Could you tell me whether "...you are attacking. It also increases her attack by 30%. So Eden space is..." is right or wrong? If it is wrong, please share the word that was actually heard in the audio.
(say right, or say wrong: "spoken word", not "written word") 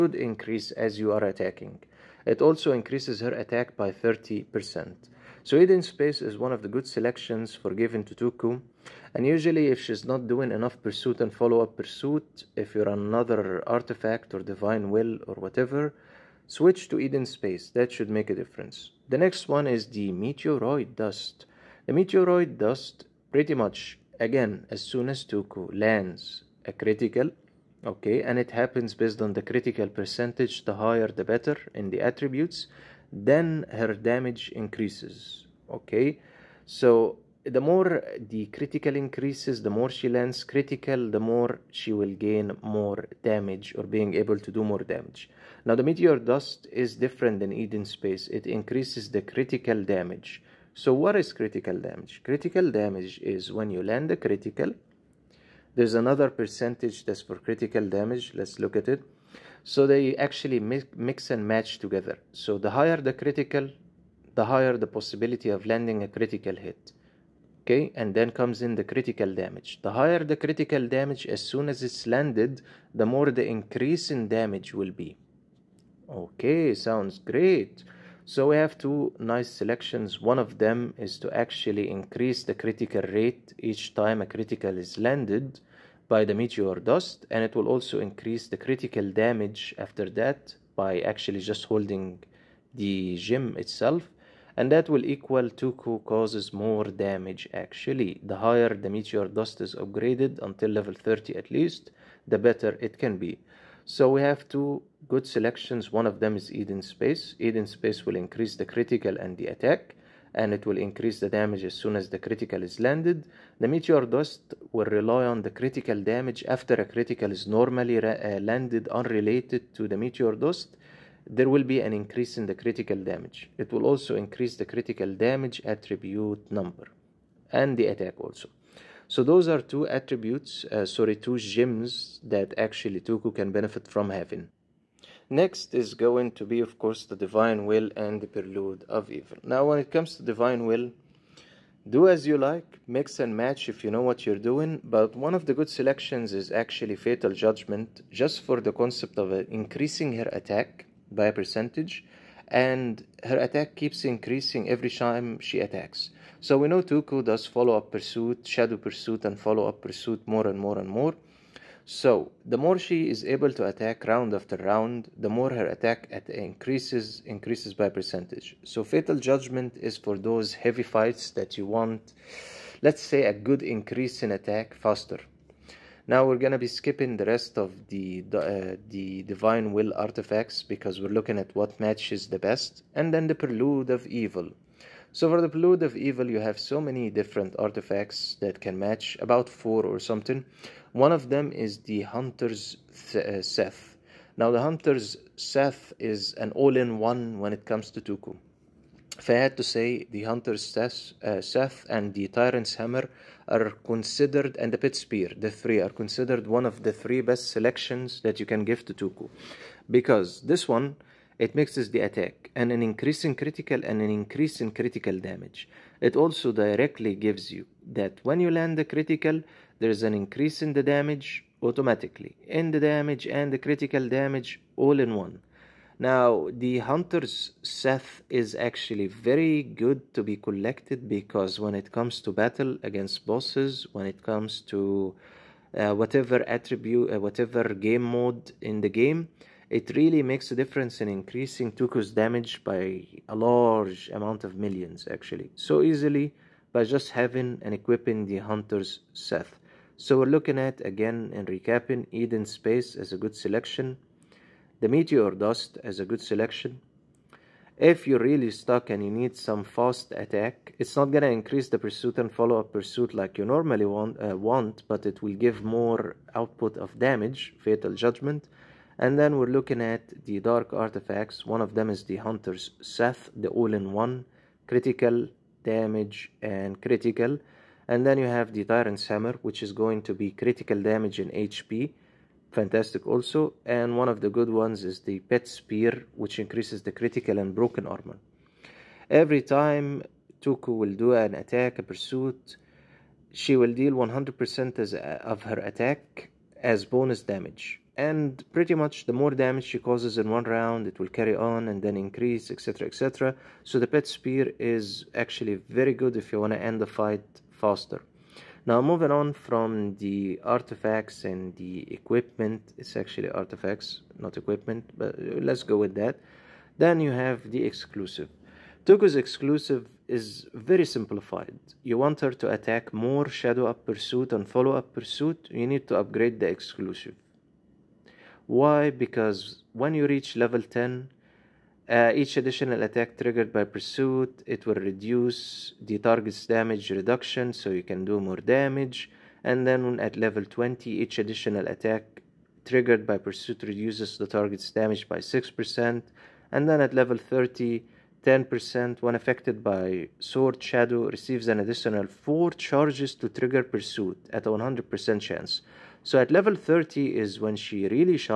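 right.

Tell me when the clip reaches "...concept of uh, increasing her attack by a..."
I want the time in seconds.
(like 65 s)
148 s.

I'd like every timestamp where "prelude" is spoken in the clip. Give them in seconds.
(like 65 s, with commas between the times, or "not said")
138 s, 183 s.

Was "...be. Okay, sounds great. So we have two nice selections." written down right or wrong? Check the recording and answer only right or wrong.
right.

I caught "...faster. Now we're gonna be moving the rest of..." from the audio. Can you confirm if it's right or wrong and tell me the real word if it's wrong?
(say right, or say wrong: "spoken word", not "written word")
wrong: "skipping", not "moving".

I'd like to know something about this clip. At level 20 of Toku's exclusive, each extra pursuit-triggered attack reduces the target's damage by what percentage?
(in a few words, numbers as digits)
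6%.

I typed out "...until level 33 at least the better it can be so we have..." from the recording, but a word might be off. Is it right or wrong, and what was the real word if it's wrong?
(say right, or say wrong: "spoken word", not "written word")
wrong: "30", not "33".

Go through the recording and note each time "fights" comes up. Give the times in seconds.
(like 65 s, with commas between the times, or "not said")
170 s, 306 s.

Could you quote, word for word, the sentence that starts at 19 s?
The next one is the meteoroid dust.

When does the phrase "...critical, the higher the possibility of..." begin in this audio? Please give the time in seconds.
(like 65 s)
63 s.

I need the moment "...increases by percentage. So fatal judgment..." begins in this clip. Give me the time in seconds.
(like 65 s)
167 s.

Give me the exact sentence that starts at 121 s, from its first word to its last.
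There will be an increase in the critical damage.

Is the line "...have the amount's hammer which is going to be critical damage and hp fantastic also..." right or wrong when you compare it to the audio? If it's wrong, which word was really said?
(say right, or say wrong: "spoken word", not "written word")
wrong: "tyrant", not "amount".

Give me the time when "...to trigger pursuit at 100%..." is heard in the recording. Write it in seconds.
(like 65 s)
353 s.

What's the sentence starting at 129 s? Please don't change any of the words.
So those are two attributes, uh, sorry, two gems that actually Toku can benefit from having.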